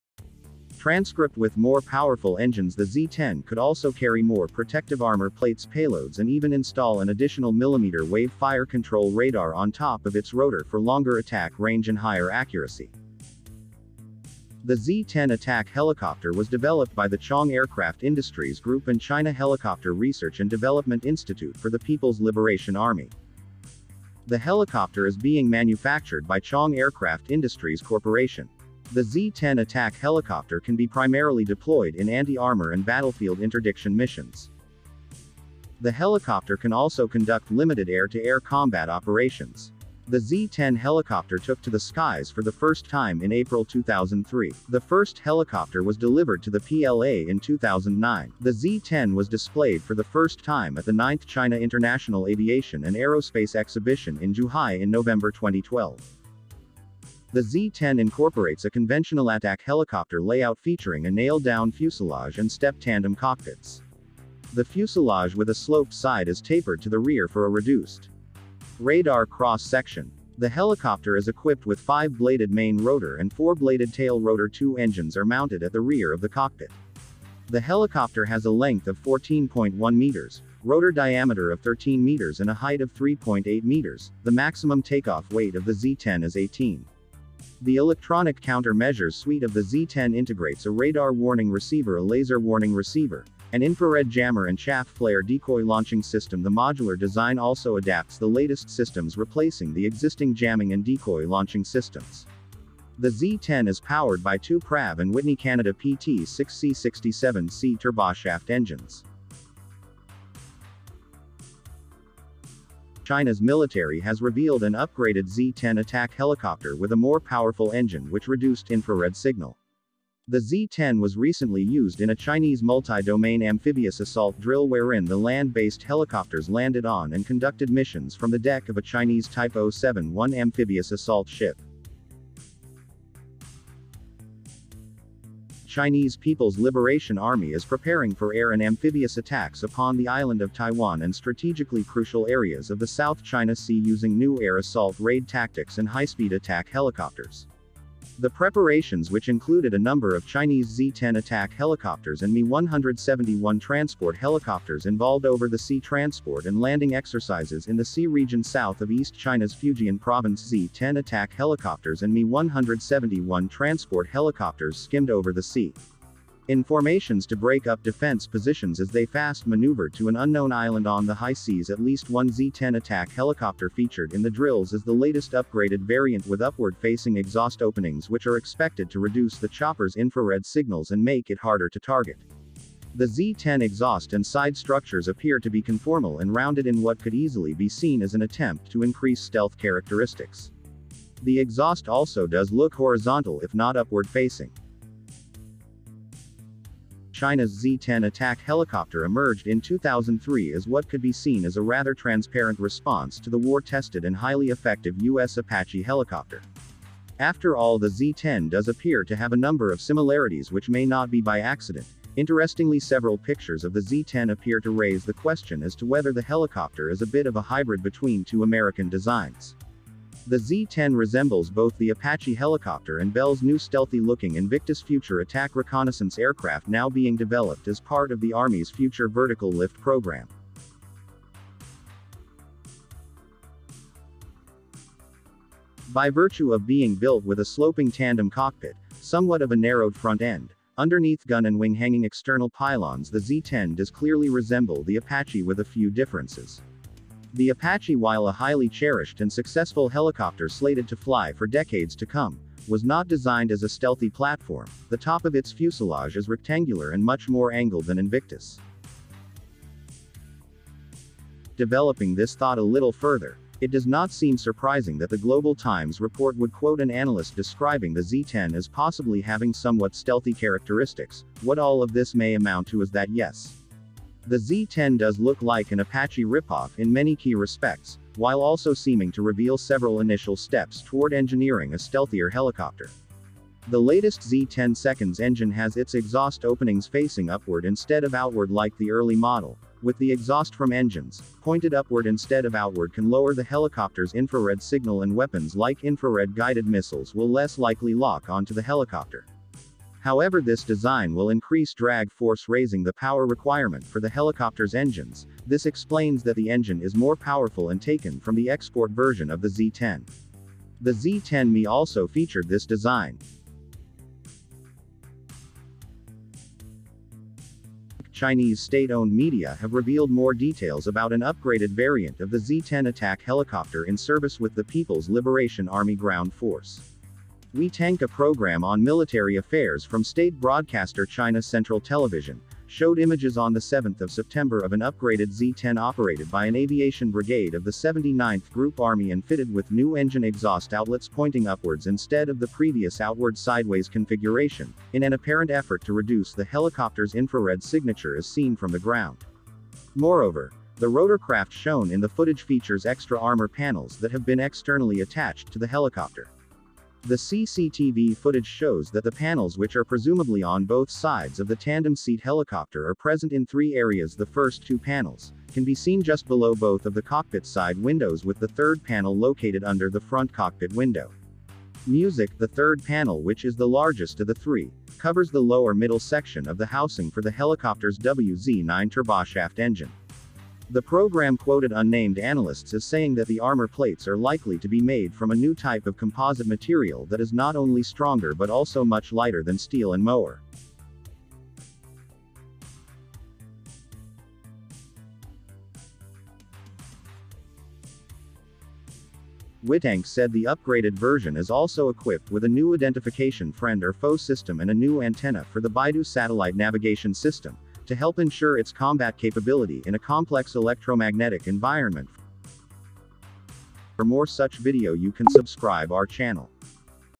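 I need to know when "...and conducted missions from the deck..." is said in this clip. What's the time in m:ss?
2:07.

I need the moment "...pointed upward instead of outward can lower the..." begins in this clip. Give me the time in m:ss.
4:51.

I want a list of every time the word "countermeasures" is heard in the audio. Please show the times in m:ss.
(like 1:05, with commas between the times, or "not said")
1:28.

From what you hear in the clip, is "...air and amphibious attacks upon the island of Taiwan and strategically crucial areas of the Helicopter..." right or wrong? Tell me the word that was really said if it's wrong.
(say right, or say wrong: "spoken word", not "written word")
wrong: "South", not "Helicopter".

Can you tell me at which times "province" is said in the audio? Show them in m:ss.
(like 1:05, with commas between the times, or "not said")
2:39.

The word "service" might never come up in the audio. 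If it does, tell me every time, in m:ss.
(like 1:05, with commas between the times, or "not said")
5:23.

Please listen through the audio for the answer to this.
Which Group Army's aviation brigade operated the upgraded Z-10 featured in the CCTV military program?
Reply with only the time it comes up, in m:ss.
5:37.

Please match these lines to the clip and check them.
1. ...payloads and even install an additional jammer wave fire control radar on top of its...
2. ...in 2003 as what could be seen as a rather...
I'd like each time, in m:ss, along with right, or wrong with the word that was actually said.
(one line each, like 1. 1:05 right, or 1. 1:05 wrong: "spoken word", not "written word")
1. 0:05 wrong: "millimeter", not "jammer"
2. 3:19 right.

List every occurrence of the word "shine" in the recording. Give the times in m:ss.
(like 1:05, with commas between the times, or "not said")
not said.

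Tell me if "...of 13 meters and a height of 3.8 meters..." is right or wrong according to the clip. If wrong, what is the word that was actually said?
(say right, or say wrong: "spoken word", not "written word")
right.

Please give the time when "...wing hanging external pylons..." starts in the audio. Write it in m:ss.
4:01.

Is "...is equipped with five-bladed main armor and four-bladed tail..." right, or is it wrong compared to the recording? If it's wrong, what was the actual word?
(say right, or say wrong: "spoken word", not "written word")
wrong: "rotor", not "armor".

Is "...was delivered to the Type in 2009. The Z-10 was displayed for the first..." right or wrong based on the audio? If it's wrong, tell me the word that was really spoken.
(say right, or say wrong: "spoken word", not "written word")
wrong: "PLA", not "Type".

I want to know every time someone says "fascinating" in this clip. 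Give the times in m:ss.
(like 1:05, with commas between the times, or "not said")
not said.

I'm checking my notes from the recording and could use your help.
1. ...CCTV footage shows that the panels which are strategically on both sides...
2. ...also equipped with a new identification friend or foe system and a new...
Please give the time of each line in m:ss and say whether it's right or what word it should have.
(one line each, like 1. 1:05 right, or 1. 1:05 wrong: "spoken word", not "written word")
1. 5:57 wrong: "presumably", not "strategically"
2. 6:41 right.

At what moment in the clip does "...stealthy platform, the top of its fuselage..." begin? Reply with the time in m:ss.
4:13.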